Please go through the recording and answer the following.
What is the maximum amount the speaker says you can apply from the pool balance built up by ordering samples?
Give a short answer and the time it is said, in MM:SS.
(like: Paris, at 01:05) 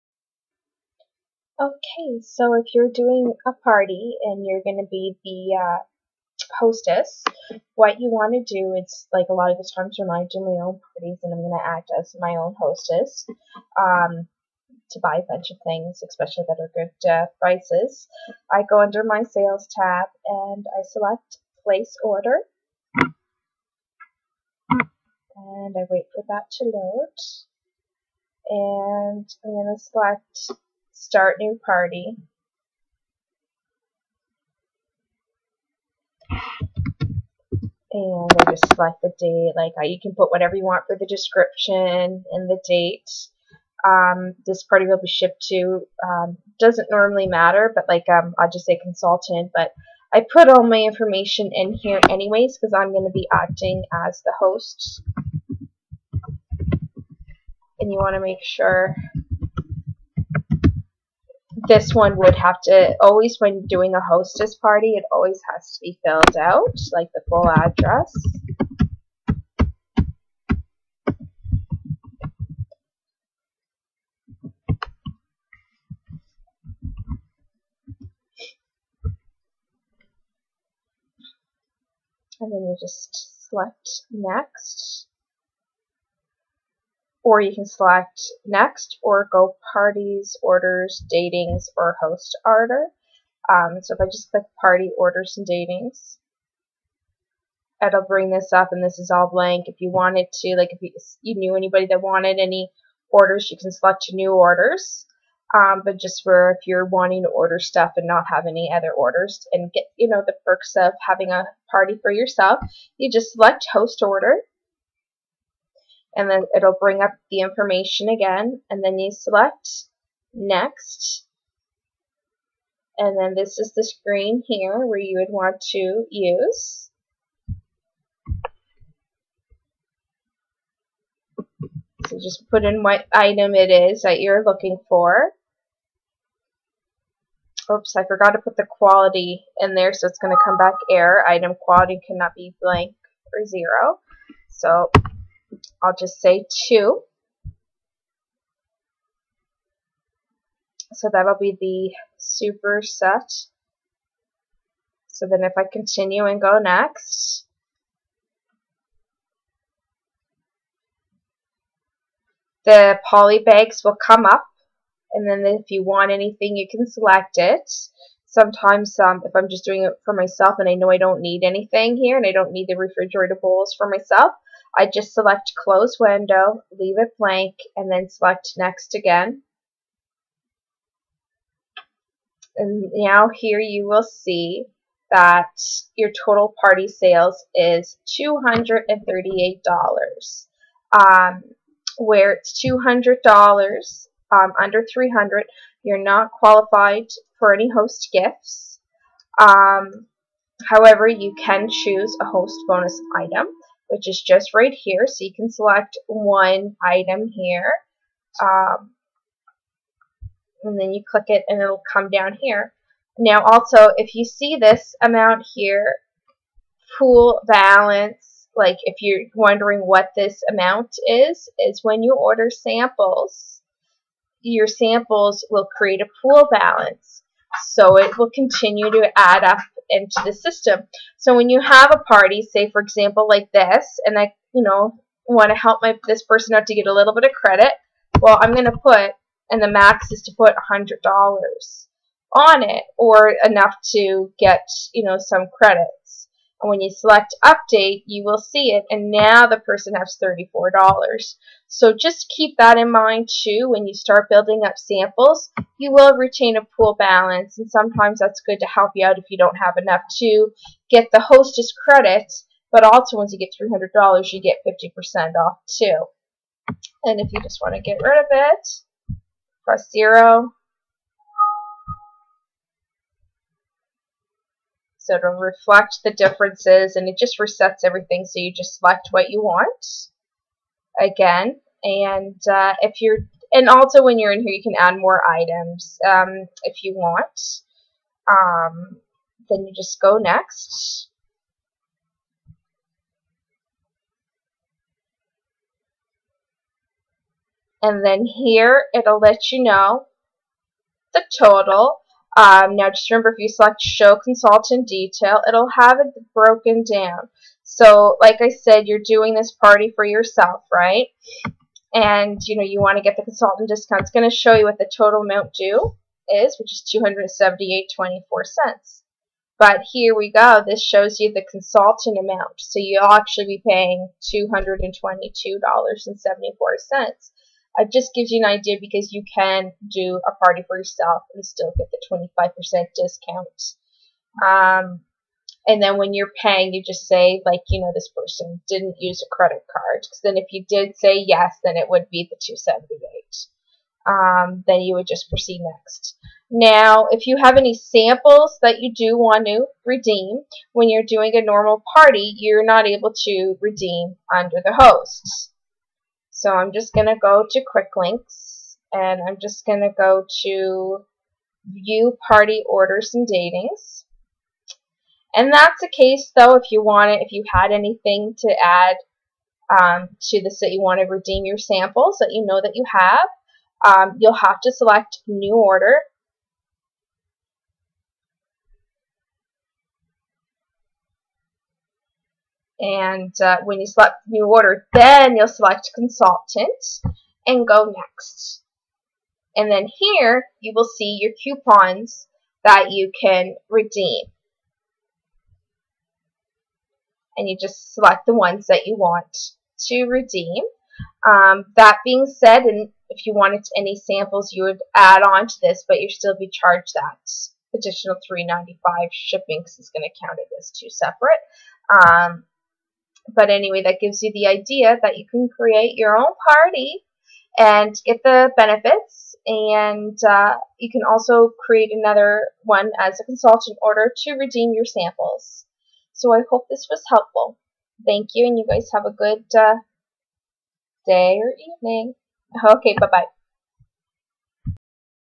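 $100, at 04:00.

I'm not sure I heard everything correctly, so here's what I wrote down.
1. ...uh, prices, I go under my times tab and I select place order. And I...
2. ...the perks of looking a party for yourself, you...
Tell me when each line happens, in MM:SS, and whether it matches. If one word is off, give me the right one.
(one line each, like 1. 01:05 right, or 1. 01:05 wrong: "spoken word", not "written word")
1. 00:17 wrong: "sales", not "times"
2. 01:50 wrong: "having", not "looking".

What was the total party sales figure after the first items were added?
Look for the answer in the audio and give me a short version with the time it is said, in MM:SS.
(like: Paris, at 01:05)
$238, at 03:08.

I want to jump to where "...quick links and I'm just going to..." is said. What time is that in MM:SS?
05:57.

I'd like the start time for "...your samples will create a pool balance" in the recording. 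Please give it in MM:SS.
03:44.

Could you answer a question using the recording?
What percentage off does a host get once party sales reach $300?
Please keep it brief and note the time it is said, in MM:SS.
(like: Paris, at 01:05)
50%, at 04:24.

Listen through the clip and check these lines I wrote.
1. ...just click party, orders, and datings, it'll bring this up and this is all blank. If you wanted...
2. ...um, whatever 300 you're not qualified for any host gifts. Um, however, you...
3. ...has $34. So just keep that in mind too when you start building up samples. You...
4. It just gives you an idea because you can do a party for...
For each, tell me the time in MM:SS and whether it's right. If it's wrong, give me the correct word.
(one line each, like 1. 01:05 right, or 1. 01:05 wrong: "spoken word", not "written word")
1. 01:34 right
2. 03:14 wrong: "under", not "whatever"
3. 04:09 right
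4. 05:27 right.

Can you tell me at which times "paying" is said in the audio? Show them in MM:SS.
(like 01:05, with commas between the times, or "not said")
05:23, 05:36.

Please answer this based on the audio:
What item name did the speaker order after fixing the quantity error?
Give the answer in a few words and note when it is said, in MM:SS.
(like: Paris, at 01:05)
superset, at 02:31.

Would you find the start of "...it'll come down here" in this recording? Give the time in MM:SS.
03:31.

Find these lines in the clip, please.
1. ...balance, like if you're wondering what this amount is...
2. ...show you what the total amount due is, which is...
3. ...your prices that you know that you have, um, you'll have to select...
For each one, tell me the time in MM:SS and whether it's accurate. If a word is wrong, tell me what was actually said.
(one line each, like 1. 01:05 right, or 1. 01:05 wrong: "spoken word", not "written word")
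1. 03:37 right
2. 05:14 right
3. 06:11 wrong: "samples", not "prices".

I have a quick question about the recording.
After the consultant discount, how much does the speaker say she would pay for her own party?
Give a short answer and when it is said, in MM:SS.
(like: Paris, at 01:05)
$222.74, at 05:24.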